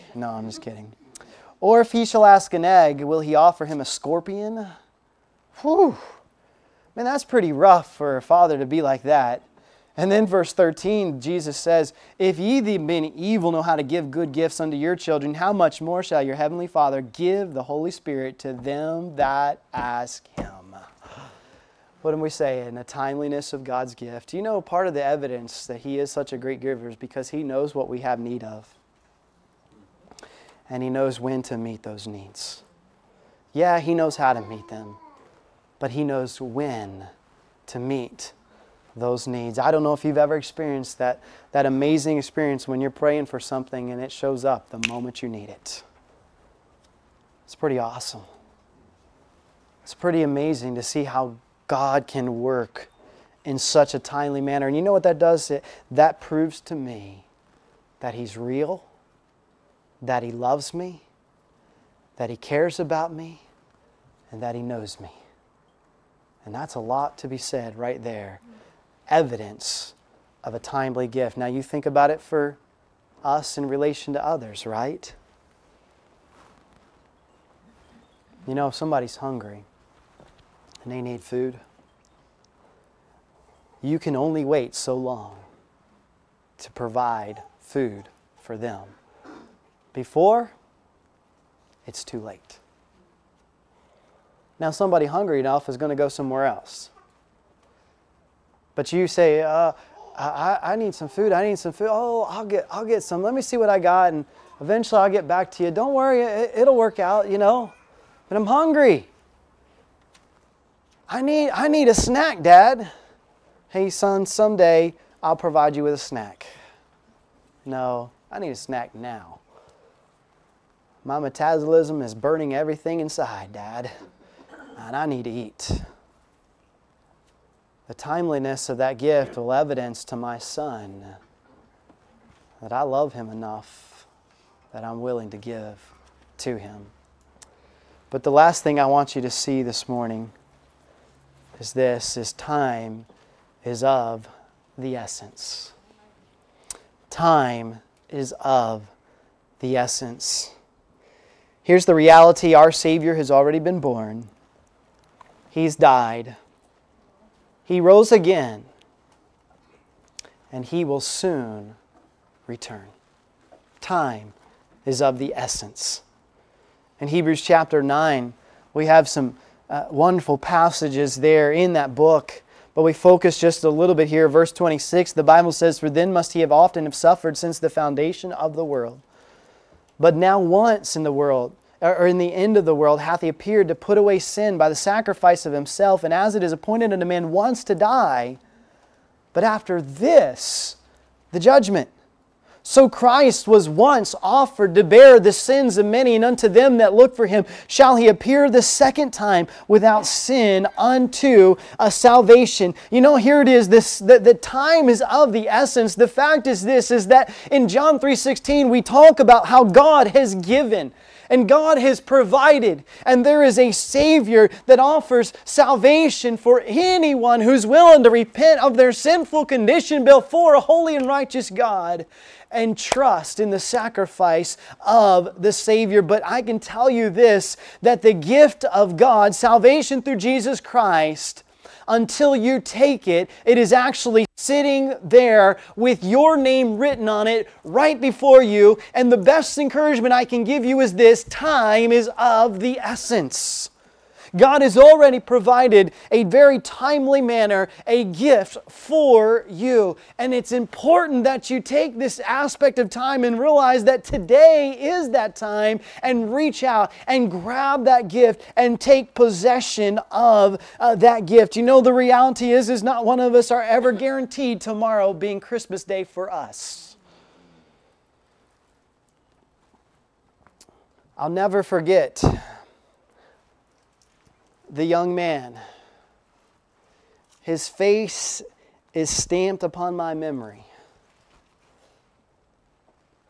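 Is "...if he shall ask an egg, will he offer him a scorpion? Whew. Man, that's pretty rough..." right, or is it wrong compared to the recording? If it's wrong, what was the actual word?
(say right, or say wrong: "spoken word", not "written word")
right.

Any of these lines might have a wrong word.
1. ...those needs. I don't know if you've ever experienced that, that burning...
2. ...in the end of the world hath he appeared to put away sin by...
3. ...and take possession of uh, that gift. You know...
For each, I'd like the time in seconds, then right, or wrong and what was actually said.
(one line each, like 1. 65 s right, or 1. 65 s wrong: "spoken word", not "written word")
1. 38 s wrong: "amazing", not "burning"
2. 182 s right
3. 258 s right.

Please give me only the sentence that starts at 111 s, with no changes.
I need, I need a snack, Dad.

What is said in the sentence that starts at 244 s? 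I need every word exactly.
God has already provided a very timely manner a gift for you.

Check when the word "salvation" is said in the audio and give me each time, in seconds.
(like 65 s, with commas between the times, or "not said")
201 s, 215 s, 229 s.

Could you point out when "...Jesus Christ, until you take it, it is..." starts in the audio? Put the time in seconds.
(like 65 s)
230 s.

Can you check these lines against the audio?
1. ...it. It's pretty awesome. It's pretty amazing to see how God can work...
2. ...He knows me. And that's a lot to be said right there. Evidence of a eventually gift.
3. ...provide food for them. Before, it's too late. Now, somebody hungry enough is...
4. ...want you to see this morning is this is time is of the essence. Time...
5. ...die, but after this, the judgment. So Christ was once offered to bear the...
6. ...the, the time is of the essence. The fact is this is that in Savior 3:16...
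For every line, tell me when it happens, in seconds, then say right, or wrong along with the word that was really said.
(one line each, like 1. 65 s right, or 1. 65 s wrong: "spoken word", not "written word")
1. 45 s right
2. 64 s wrong: "timely", not "eventually"
3. 86 s right
4. 138 s right
5. 187 s right
6. 203 s wrong: "John", not "Savior".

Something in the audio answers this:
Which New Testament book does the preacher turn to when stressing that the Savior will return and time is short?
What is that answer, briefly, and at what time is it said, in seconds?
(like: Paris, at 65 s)
Hebrews, at 167 s.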